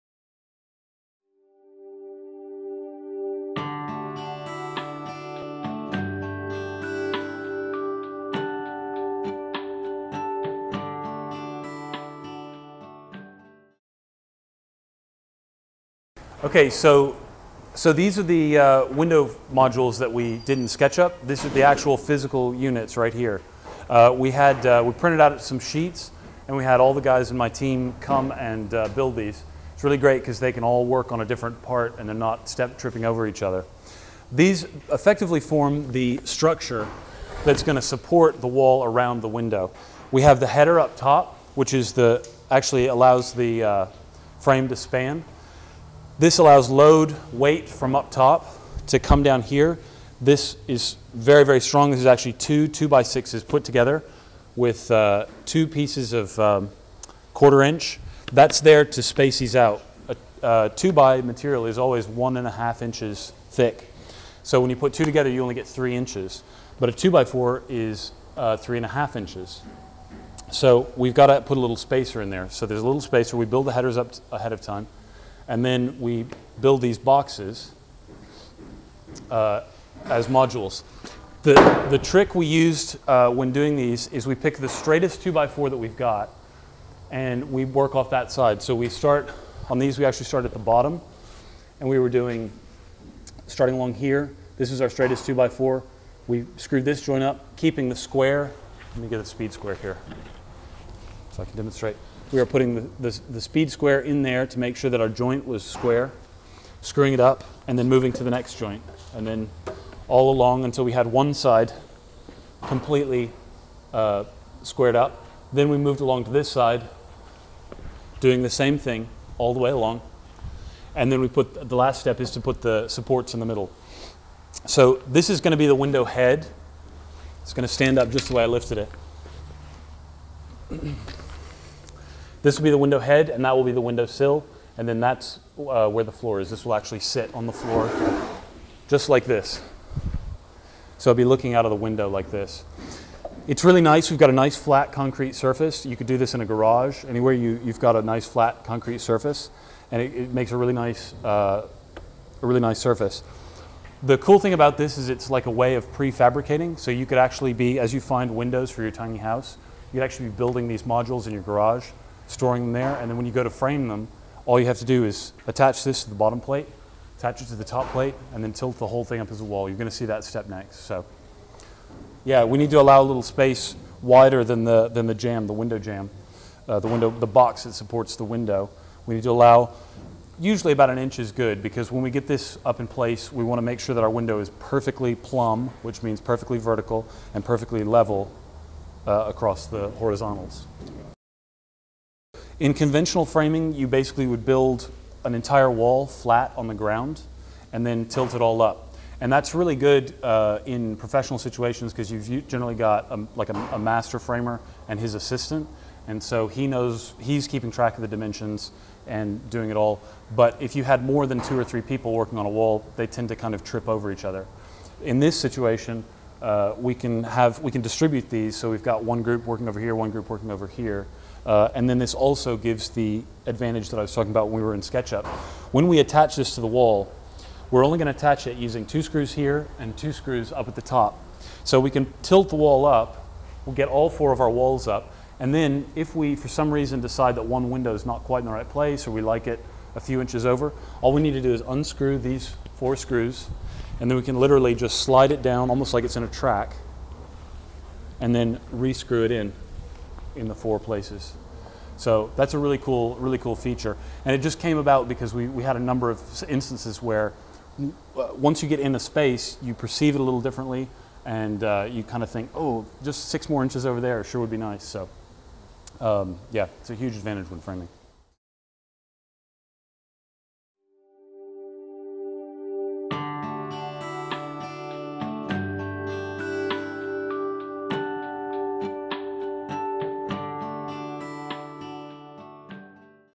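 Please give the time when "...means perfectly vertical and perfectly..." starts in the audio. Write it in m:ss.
3:06.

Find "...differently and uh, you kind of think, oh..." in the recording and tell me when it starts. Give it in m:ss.
4:20.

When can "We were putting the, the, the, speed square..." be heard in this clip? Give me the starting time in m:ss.
1:42.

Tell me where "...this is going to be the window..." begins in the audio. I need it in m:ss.
2:05.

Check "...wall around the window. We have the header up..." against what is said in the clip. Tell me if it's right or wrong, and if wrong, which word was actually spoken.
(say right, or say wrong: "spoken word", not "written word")
right.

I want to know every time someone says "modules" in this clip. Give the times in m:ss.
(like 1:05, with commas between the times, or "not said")
0:19, 1:20, 2:40.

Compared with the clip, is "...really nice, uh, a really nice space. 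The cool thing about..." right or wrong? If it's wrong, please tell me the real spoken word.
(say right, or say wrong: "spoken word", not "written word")
wrong: "surface", not "space".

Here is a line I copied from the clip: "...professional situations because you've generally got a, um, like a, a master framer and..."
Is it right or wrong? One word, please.
right.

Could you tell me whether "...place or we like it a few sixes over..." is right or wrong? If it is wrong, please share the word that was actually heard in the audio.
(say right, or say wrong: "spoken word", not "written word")
wrong: "inches", not "sixes".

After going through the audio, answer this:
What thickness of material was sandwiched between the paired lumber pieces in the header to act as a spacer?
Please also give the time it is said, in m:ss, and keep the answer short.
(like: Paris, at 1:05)
quarter inch, at 0:57.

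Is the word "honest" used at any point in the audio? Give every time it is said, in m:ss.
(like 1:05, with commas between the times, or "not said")
not said.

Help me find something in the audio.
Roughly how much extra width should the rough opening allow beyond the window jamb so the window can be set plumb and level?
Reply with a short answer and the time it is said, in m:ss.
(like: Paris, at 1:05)
about an inch, at 3:00.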